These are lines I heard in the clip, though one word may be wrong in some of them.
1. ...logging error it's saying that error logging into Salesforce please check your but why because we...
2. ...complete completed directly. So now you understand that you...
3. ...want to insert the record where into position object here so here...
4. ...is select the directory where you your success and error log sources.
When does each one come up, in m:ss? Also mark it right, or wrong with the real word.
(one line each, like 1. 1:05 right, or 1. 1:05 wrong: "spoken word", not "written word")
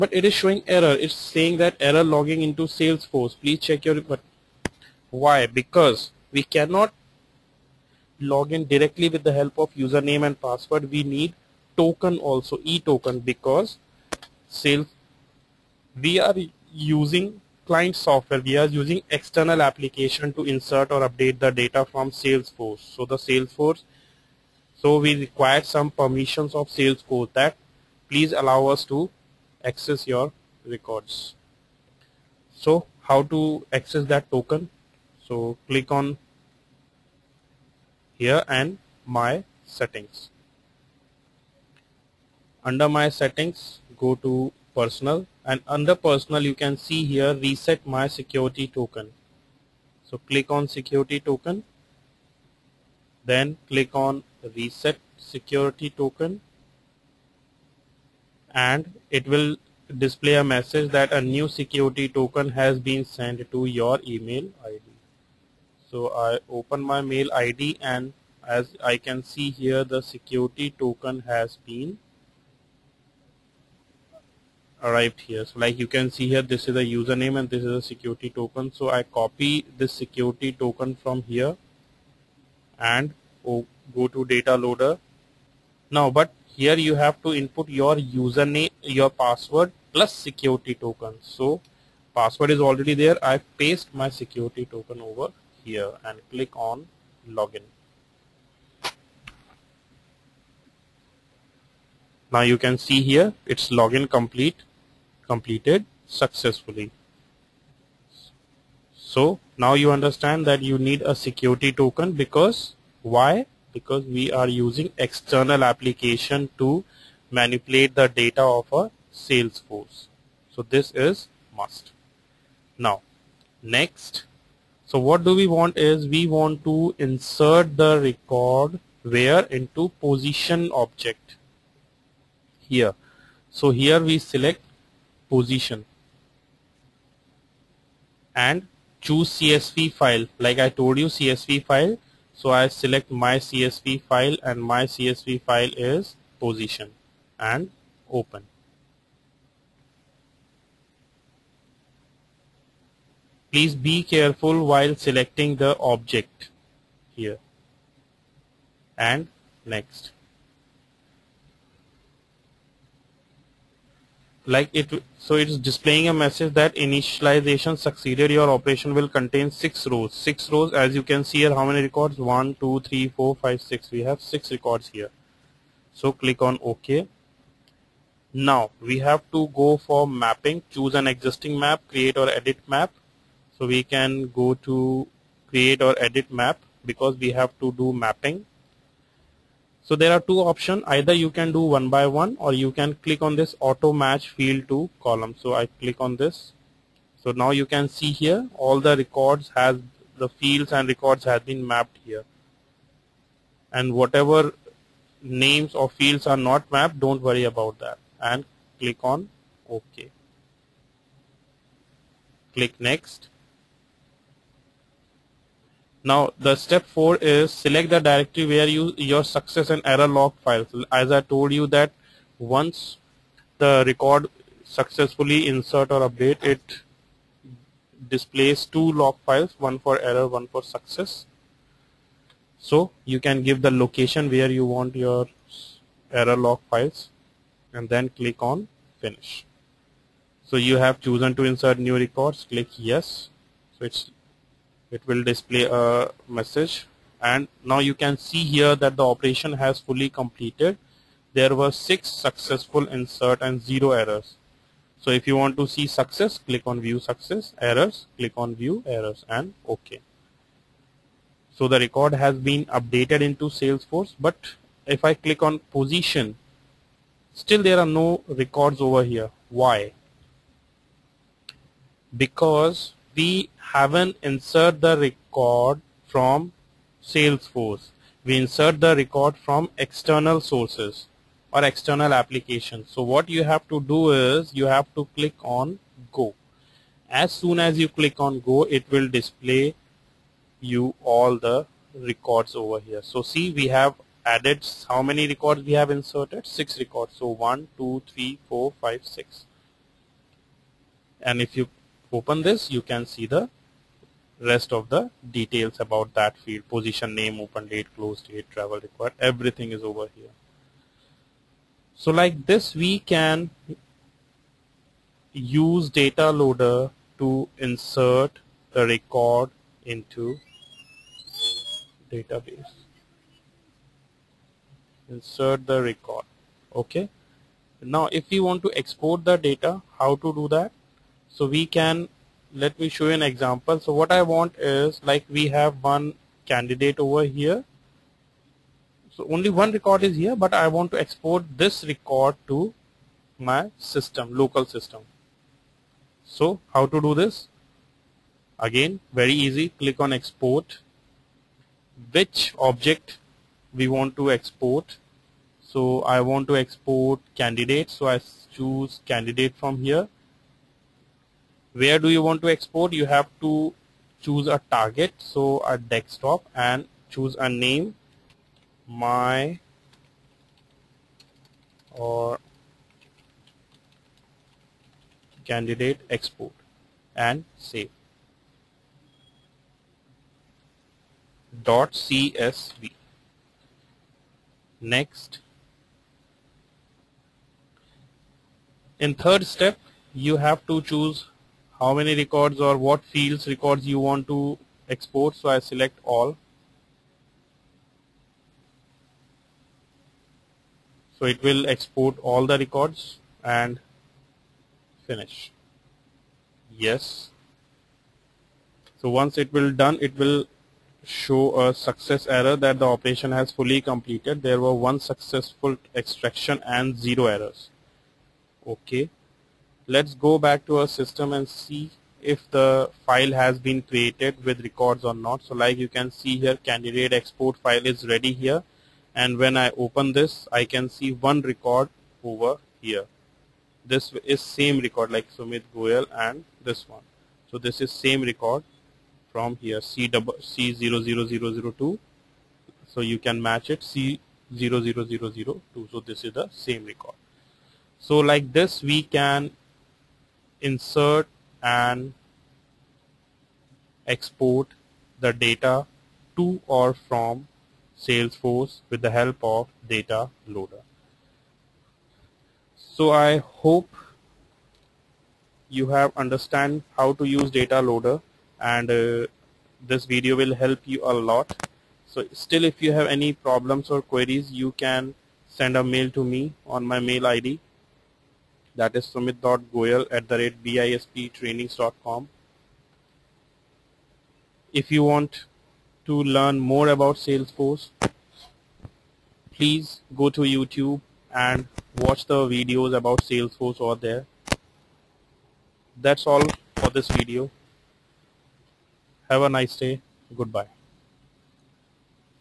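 1. 0:00 wrong: "showing", not "logging"
2. 1:44 wrong: "successfully", not "directly"
3. 2:06 right
4. 3:37 wrong: "files", not "sources".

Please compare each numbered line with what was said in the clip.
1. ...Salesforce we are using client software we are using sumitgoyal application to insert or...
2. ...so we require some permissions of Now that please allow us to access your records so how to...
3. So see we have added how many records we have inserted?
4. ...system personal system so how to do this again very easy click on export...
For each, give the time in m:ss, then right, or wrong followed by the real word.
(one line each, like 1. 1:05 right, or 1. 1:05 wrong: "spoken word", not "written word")
1. 0:14 wrong: "external", not "sumitgoyal"
2. 0:24 wrong: "Salesforce", not "Now"
3. 4:53 right
4. 5:43 wrong: "local", not "personal".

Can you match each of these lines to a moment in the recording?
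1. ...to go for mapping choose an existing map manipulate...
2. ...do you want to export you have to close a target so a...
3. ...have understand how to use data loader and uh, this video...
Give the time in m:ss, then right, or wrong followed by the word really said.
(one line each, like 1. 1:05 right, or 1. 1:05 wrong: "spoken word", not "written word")
1. 2:59 wrong: "create", not "manipulate"
2. 6:01 wrong: "choose", not "close"
3. 7:45 right.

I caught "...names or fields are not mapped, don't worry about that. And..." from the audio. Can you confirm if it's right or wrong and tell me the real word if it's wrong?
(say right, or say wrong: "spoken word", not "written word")
right.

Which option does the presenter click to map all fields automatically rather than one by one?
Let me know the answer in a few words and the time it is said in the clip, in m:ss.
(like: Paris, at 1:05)
Auto match field to column, at 3:13.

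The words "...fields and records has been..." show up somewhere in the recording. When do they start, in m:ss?
3:20.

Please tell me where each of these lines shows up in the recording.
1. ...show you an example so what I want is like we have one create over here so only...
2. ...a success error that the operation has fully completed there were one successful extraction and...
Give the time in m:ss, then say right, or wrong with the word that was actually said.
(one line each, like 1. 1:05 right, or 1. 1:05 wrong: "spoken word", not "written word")
1. 5:32 wrong: "candidate", not "create"
2. 6:51 right.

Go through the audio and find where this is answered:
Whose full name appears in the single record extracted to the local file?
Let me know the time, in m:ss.
7:15.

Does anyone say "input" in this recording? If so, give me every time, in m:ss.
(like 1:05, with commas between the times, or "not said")
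1:27.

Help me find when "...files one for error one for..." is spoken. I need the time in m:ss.
3:49.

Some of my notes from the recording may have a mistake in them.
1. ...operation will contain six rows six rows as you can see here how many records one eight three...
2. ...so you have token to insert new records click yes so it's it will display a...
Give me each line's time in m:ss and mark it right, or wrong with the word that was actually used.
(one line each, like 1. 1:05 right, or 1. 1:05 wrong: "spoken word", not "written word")
1. 2:48 wrong: "two", not "eight"
2. 4:00 wrong: "chosen", not "token".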